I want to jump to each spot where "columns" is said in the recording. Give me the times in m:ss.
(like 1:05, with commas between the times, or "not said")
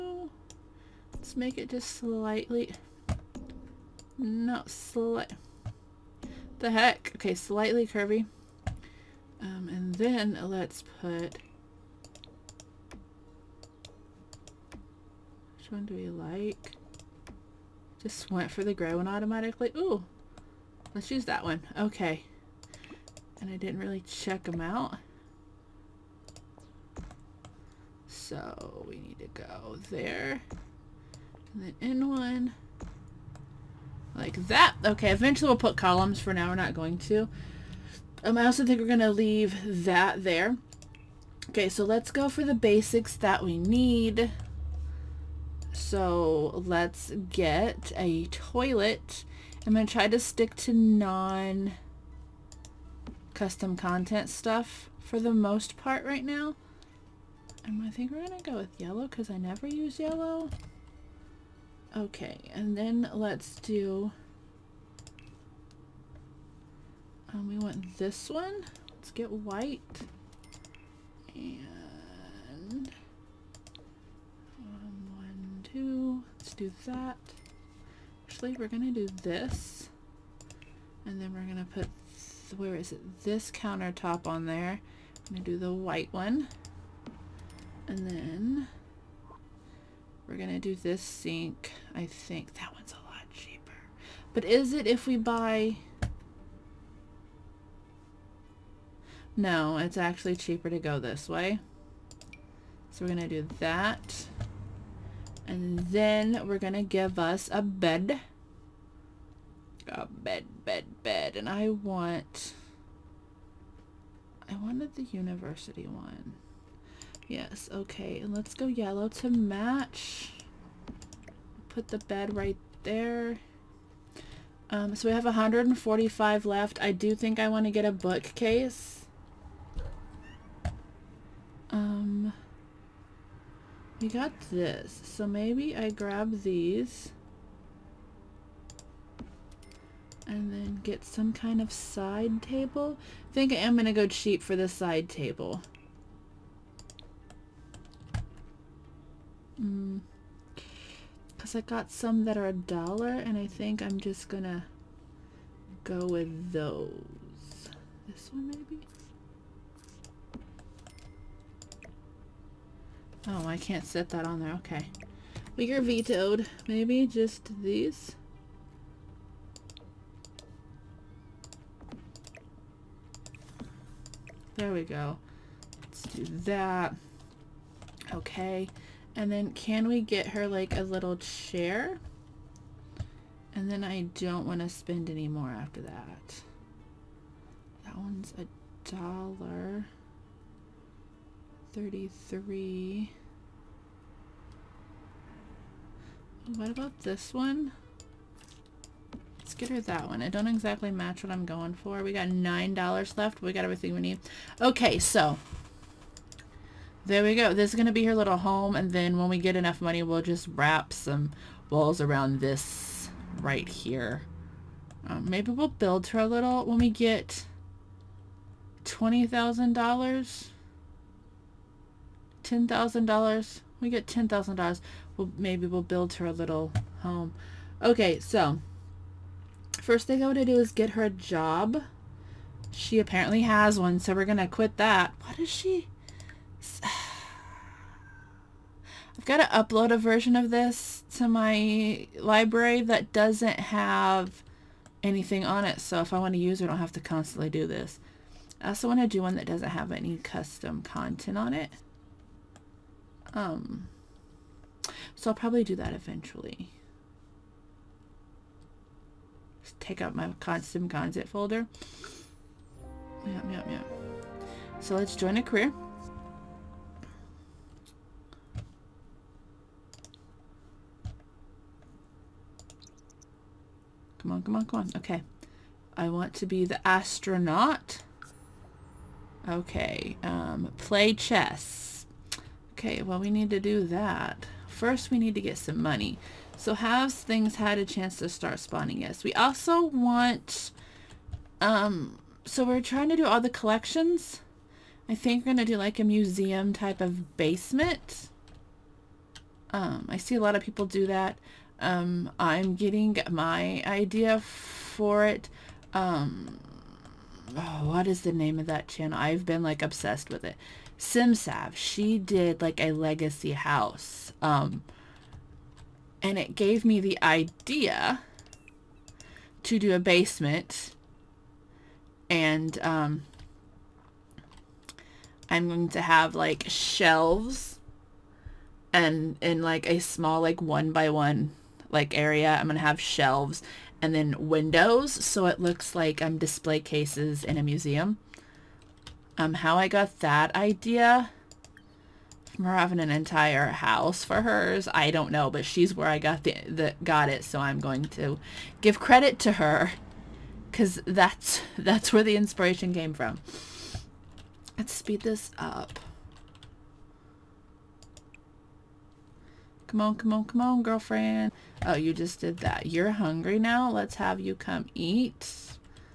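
0:35.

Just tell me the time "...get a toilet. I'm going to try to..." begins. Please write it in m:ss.
0:47.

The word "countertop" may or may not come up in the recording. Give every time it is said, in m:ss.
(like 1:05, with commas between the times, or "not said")
1:23.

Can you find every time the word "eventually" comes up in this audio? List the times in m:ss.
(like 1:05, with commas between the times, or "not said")
0:35, 4:15.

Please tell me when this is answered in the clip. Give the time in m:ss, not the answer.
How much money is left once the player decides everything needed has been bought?
3:22.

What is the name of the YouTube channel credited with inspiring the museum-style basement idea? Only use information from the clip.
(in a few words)
SimSav.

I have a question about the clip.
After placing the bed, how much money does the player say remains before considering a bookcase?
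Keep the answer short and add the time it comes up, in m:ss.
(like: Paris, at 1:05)
145, at 2:05.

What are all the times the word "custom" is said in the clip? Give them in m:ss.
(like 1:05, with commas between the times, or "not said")
0:53, 4:10, 4:20.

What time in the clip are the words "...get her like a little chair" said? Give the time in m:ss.
3:00.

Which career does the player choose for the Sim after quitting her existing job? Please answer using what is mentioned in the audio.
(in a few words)
astronaut.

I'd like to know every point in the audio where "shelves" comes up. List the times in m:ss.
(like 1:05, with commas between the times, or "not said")
5:26, 5:32.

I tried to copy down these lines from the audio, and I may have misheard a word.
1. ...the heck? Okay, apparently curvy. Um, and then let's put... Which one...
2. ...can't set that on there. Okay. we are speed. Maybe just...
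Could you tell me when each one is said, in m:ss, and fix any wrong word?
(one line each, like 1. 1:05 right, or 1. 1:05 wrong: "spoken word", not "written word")
1. 0:06 wrong: "slightly", not "apparently"
2. 2:43 wrong: "vetoed", not "speed".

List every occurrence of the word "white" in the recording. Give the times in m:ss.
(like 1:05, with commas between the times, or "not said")
1:09, 1:25.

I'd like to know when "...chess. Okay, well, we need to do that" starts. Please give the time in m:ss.
4:41.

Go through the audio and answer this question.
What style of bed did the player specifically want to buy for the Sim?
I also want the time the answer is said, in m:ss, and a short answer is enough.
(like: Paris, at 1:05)
university, at 1:55.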